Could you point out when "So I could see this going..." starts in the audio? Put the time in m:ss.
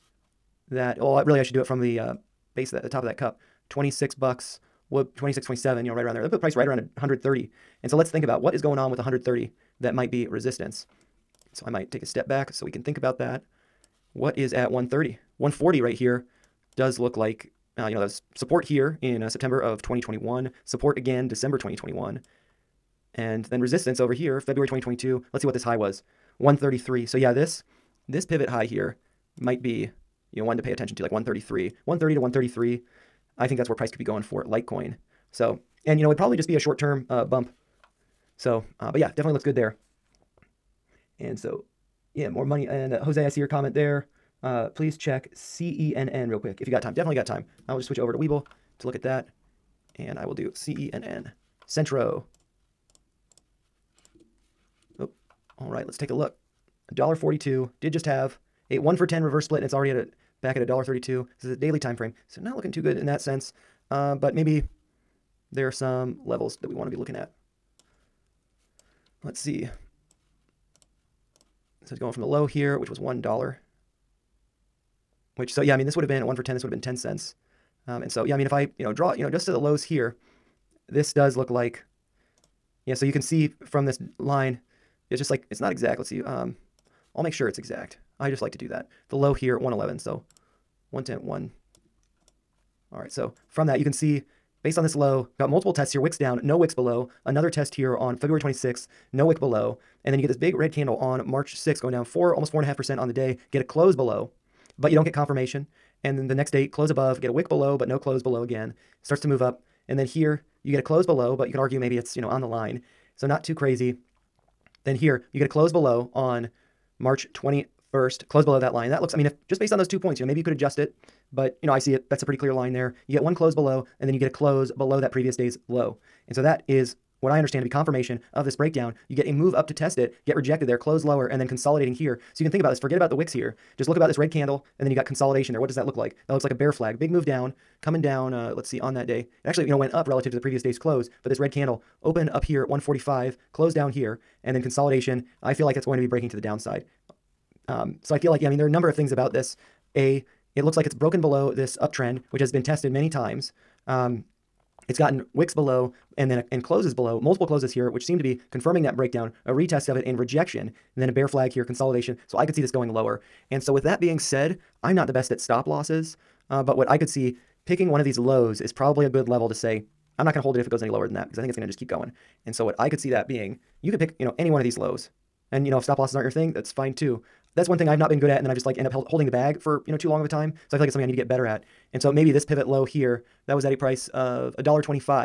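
2:42.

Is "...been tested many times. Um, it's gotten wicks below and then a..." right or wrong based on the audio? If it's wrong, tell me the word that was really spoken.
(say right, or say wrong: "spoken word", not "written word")
right.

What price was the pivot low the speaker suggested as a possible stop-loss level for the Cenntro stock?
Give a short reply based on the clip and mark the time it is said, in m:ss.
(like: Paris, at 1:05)
$1.25, at 3:04.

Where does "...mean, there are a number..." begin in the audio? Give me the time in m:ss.
2:28.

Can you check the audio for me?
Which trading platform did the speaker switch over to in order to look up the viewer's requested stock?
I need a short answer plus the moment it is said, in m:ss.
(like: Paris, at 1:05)
Webull, at 0:48.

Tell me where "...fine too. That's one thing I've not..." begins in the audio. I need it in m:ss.
2:56.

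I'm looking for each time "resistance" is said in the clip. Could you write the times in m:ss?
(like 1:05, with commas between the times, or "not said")
0:10, 0:23.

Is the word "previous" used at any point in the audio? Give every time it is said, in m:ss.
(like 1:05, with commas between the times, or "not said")
2:05, 2:20.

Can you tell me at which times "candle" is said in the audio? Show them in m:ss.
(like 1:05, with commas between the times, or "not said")
1:40, 2:14, 2:21.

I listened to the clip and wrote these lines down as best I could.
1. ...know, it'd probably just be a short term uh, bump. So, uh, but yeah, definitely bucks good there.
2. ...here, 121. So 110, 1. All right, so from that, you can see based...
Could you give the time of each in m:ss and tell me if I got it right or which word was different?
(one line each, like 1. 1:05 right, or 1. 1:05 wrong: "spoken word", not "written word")
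1. 0:36 wrong: "looks", not "bucks"
2. 1:29 wrong: "111", not "121".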